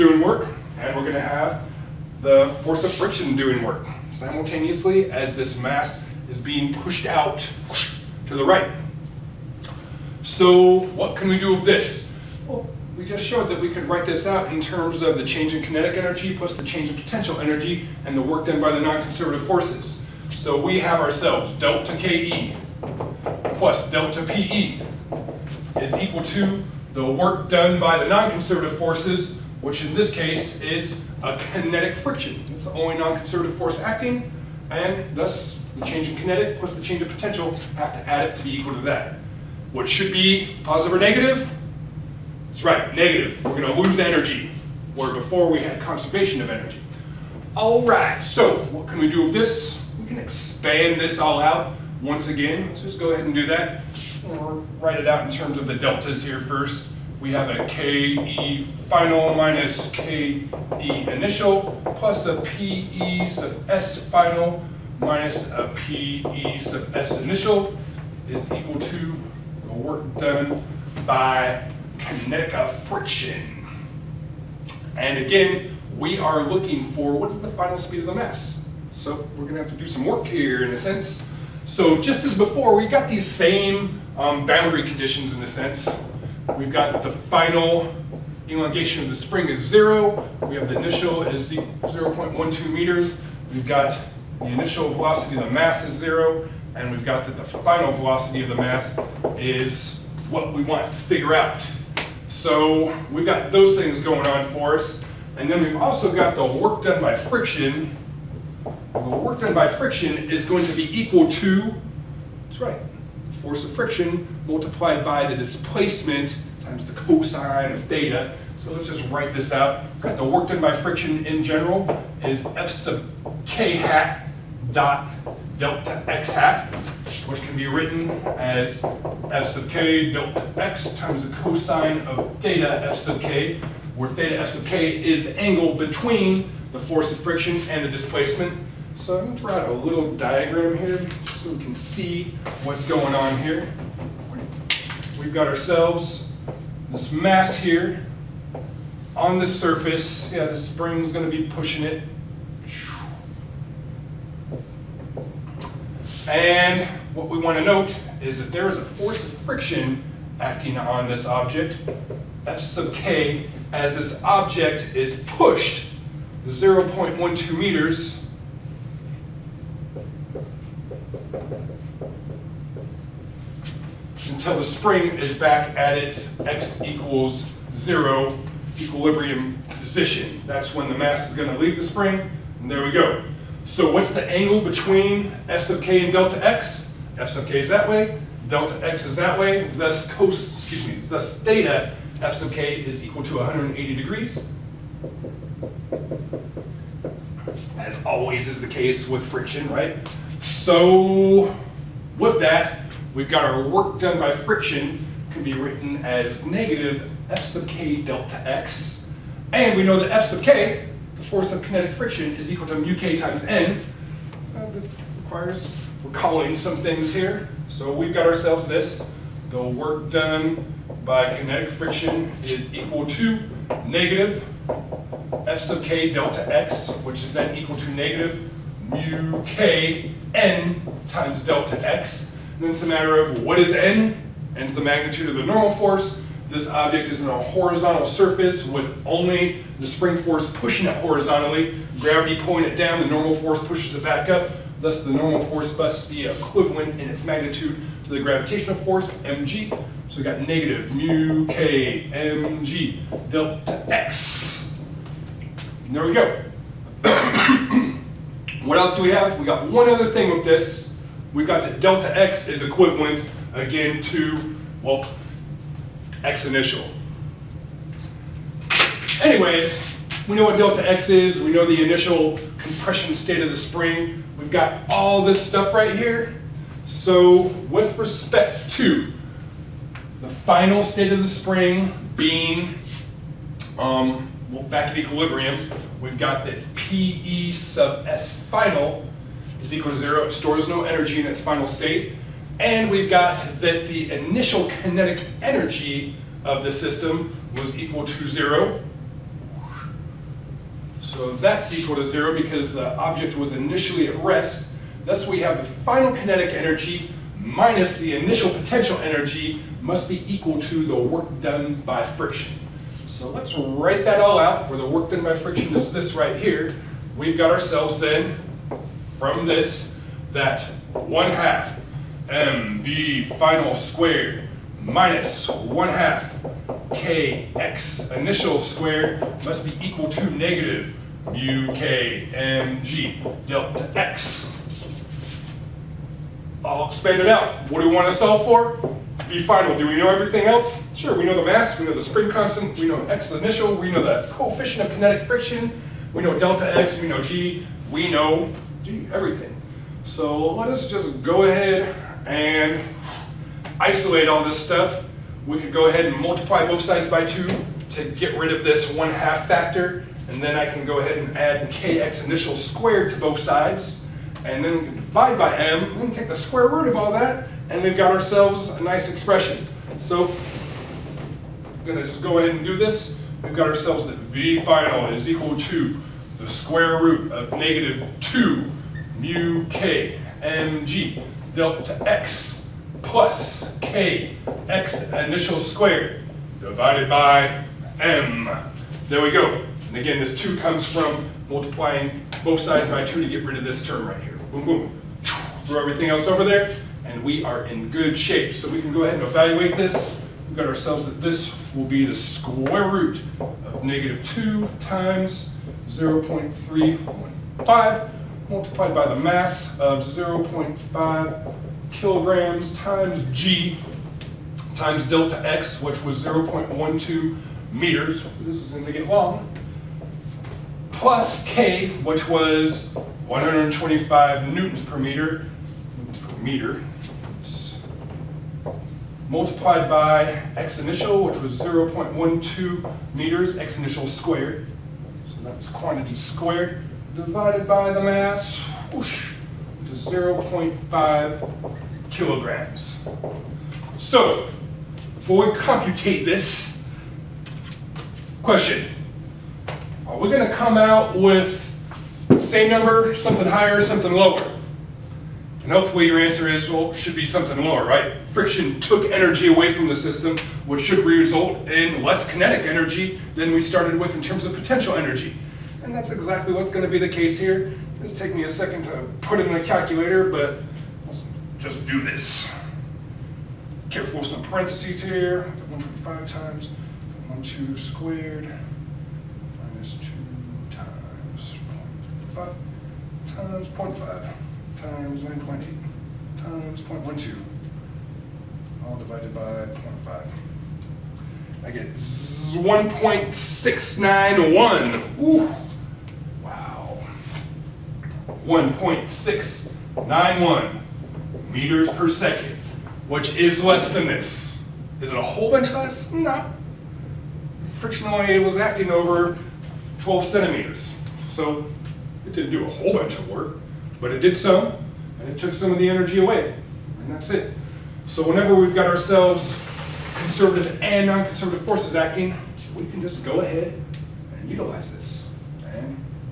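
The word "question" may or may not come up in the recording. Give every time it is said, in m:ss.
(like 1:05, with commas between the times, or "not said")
7:28.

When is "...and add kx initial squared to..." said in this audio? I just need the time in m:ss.
6:01.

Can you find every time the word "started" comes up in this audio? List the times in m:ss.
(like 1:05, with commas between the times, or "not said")
7:43.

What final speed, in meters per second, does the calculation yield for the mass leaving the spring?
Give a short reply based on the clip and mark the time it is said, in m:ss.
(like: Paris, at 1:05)
1.691 meters per second, at 8:18.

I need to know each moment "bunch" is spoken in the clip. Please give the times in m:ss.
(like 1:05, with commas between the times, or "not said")
8:25, 8:32.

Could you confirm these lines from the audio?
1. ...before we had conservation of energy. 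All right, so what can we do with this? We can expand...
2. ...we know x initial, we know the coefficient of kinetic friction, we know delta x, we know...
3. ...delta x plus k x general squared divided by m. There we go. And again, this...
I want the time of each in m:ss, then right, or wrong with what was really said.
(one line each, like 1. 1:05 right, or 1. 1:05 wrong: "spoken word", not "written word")
1. 0:45 right
2. 5:42 right
3. 6:21 wrong: "initial", not "general".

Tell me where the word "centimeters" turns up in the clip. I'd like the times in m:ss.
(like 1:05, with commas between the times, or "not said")
8:30.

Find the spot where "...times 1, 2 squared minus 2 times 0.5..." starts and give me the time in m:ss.
7:56.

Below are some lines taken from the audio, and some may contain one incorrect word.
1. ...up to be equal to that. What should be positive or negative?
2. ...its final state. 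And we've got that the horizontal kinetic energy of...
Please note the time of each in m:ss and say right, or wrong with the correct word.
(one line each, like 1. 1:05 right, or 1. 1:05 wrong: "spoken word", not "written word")
1. 0:38 right
2. 4:51 wrong: "initial", not "horizontal".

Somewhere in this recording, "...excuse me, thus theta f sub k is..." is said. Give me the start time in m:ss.
3:10.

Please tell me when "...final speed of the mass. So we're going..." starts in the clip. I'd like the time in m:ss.
1:17.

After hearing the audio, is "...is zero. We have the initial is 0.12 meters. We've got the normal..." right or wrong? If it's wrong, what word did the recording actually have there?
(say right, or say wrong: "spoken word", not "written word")
wrong: "initial", not "normal".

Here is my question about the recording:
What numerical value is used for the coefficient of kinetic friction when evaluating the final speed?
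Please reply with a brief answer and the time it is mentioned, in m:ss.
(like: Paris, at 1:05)
0.315, at 6:45.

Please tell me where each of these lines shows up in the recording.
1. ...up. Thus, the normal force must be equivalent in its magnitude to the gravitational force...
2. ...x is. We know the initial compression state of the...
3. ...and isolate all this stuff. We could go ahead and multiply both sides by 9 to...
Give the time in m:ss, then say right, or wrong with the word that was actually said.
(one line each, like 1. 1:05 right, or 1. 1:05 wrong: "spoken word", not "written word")
1. 4:04 right
2. 4:30 right
3. 5:52 wrong: "2", not "9".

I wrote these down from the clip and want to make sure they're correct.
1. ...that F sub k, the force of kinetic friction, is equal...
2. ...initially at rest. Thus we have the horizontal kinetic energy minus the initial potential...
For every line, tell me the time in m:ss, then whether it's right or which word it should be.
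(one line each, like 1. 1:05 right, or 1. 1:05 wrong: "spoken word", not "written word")
1. 3:29 right
2. 5:03 wrong: "final", not "horizontal".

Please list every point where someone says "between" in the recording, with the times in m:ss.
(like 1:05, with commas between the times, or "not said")
2:15, 3:04.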